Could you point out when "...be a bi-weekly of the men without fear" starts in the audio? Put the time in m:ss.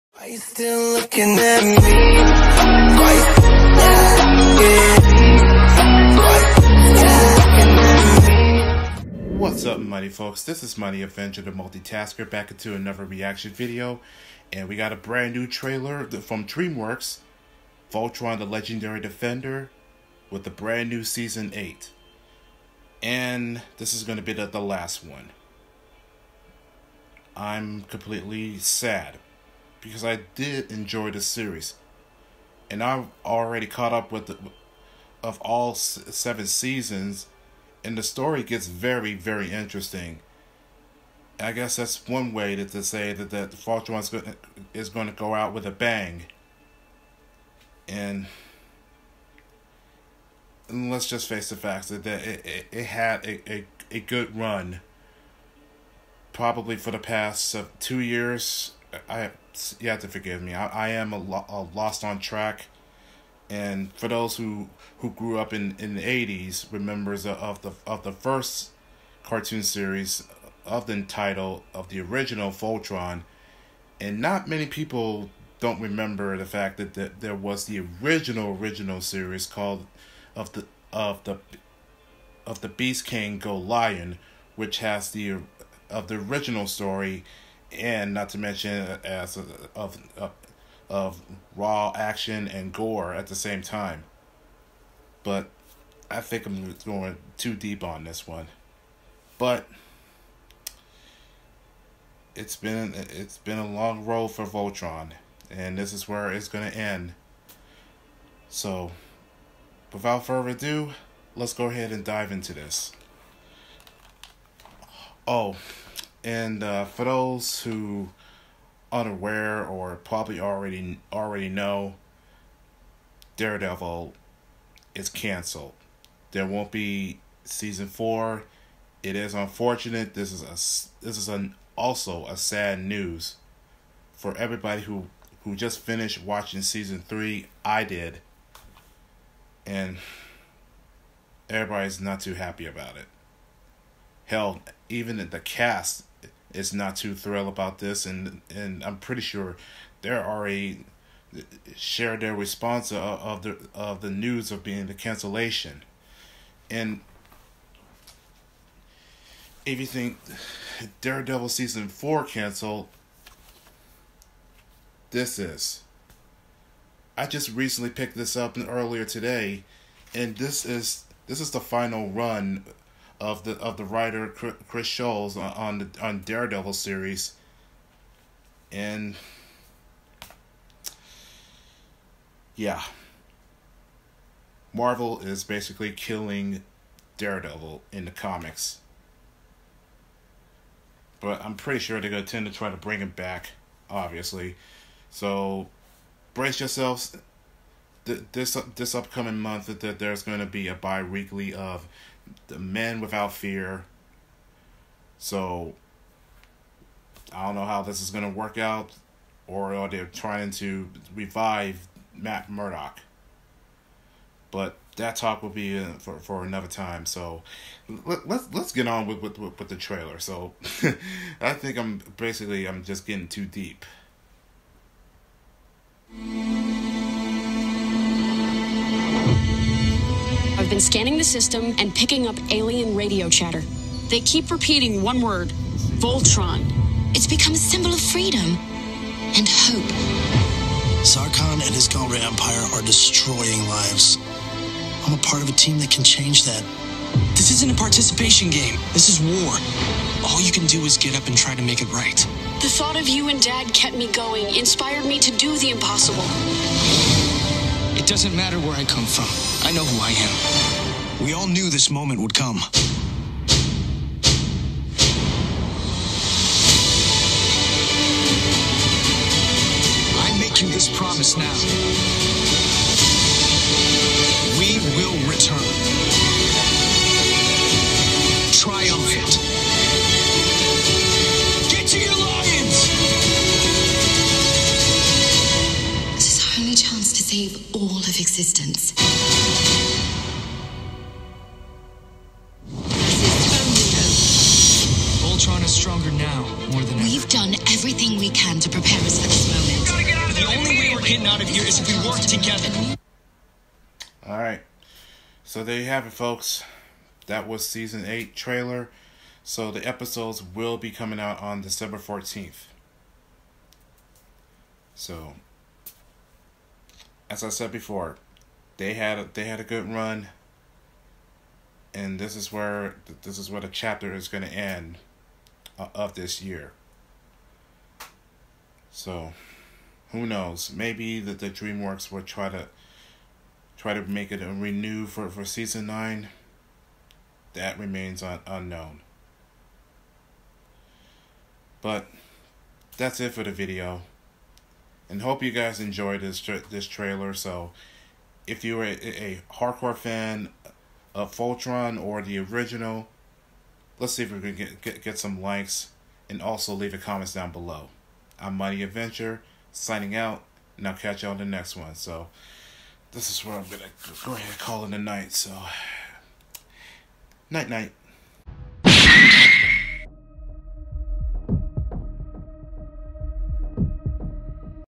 3:20.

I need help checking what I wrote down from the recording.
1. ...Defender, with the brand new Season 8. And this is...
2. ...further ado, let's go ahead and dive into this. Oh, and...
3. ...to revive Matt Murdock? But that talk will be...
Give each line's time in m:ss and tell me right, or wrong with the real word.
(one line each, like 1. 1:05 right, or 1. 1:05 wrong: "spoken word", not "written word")
1. 0:19 right
2. 1:50 right
3. 3:30 right.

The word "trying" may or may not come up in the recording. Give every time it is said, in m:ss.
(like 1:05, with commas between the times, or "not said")
3:30.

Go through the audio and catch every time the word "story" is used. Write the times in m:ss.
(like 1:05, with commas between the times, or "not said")
0:38, 1:26.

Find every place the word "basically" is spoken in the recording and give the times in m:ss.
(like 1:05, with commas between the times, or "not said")
3:05, 3:42.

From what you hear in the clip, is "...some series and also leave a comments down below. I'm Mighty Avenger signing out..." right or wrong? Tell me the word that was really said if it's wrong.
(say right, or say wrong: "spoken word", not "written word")
wrong: "likes", not "series".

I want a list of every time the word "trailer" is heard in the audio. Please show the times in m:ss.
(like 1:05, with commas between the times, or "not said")
0:15, 3:39, 5:08, 5:46.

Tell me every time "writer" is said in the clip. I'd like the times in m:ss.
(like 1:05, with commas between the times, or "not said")
2:53.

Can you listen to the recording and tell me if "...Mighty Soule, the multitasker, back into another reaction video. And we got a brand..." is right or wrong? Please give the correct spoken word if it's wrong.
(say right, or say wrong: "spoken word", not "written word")
wrong: "Avenger", not "Soule".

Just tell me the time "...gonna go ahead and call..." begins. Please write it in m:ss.
6:03.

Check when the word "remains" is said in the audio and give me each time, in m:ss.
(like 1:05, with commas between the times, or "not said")
5:37.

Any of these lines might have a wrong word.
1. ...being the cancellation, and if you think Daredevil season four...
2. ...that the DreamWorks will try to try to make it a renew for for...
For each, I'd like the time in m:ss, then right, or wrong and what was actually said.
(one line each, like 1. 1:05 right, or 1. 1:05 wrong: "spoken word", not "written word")
1. 2:34 right
2. 5:31 right.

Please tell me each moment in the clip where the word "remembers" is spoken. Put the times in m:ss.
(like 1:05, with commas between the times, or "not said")
1:06, 1:15.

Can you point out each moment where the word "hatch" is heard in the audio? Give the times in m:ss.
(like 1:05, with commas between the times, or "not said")
not said.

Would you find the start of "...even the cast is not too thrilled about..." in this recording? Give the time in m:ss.
2:24.